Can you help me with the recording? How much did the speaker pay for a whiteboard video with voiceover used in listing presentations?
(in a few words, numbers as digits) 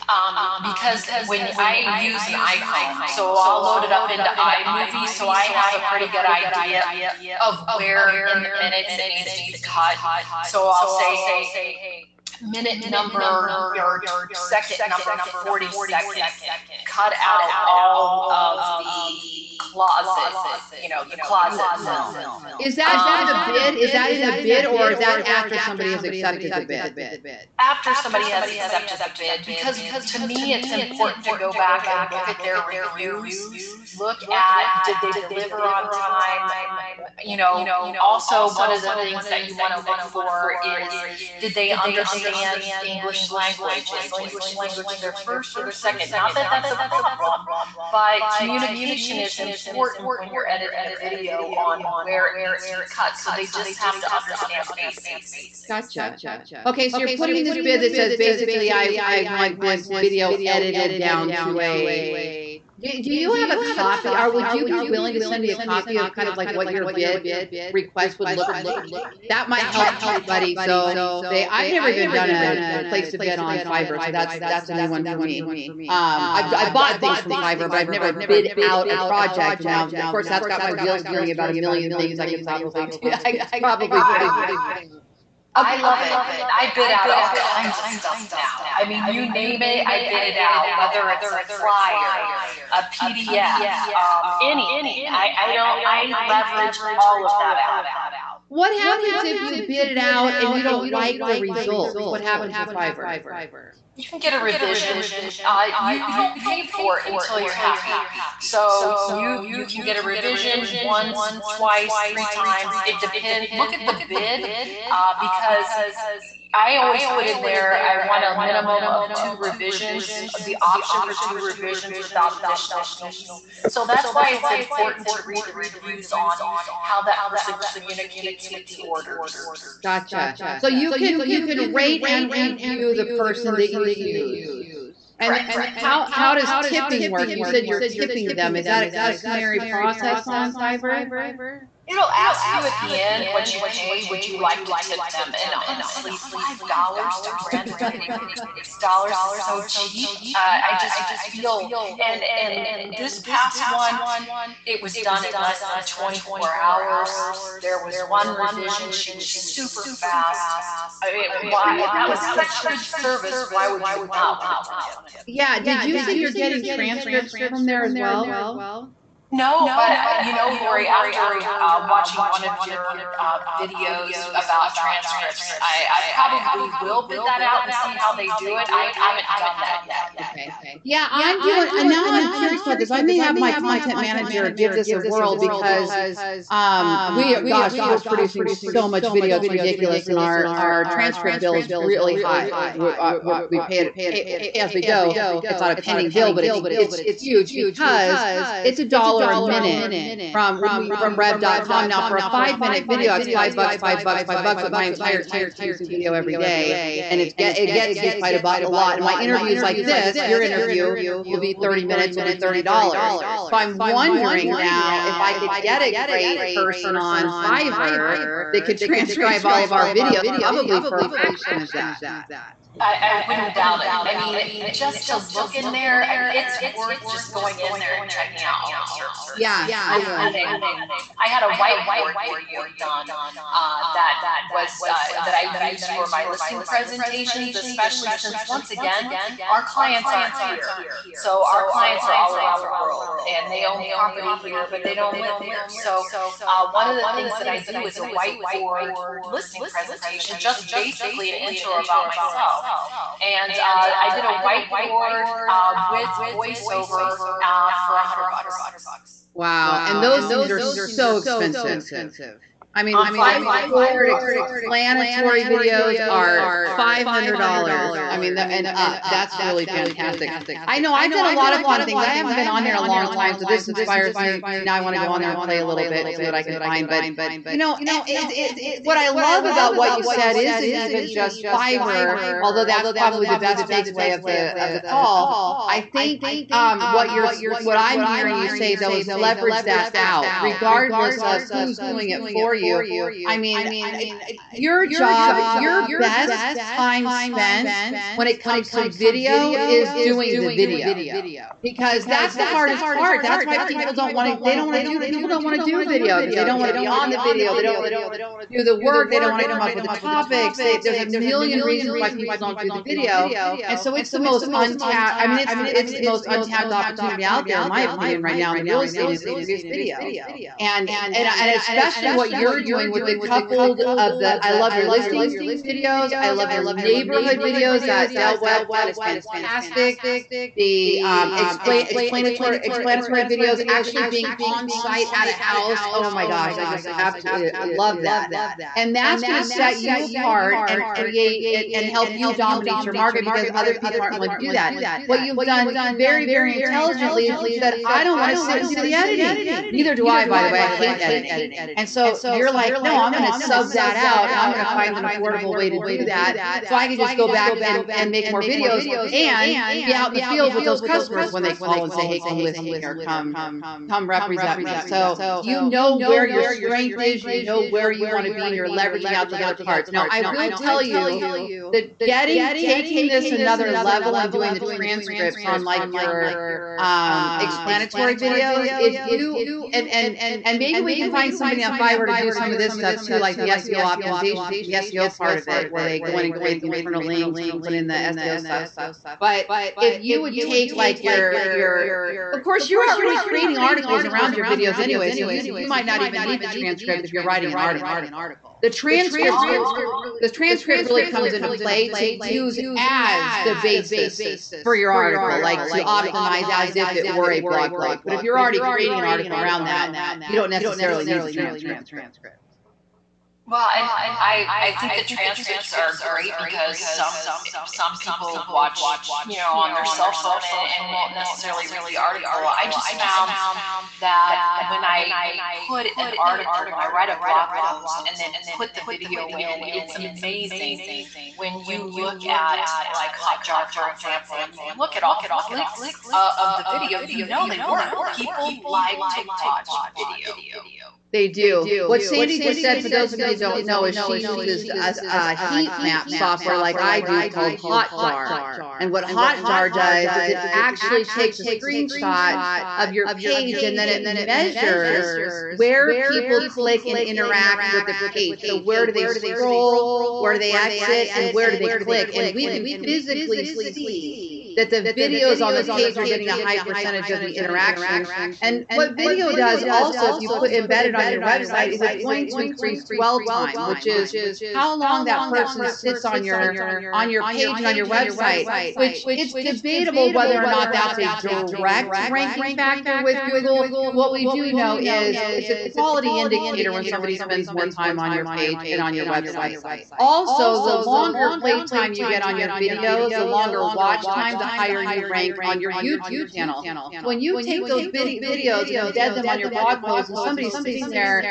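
$100.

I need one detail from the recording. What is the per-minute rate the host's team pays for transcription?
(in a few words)
$1 a minute.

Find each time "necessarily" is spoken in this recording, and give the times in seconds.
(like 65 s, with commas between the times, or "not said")
410 s, 421 s.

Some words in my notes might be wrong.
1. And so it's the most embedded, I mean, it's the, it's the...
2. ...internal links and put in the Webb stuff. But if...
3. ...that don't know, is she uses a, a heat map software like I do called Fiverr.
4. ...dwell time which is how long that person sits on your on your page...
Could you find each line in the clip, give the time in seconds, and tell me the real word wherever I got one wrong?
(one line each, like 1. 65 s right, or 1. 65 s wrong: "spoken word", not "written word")
1. 313 s wrong: "untapped", not "embedded"
2. 386 s wrong: "SEO", not "Webb"
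3. 443 s wrong: "Hotjar", not "Fiverr"
4. 472 s right.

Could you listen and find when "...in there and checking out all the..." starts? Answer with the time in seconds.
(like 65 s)
227 s.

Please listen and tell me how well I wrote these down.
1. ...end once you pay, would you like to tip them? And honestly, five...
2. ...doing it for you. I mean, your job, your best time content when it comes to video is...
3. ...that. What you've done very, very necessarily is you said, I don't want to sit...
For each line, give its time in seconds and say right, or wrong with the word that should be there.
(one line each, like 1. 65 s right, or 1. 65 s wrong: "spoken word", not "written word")
1. 142 s right
2. 291 s wrong: "spent", not "content"
3. 344 s wrong: "intelligently", not "necessarily".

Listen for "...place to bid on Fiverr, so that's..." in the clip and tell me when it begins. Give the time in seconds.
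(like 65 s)
72 s.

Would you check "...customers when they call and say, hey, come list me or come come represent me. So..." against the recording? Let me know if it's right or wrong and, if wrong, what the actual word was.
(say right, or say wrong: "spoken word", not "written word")
right.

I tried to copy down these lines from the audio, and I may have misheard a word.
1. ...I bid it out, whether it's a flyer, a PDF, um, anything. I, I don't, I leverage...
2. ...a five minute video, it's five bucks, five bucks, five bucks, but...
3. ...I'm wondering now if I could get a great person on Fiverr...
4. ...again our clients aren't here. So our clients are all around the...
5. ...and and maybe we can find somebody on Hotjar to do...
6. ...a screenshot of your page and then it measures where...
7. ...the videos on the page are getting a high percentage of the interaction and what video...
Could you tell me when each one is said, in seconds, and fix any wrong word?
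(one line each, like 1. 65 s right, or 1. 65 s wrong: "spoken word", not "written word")
1. 89 s right
2. 202 s right
3. 213 s right
4. 238 s right
5. 379 s wrong: "Fiverr", not "Hotjar"
6. 451 s right
7. 464 s right.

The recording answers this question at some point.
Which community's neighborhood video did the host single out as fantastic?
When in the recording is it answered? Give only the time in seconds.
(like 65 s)
328 s.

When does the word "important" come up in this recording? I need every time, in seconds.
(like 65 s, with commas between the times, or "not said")
30 s, 49 s, 124 s.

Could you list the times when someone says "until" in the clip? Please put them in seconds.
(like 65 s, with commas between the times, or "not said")
107 s.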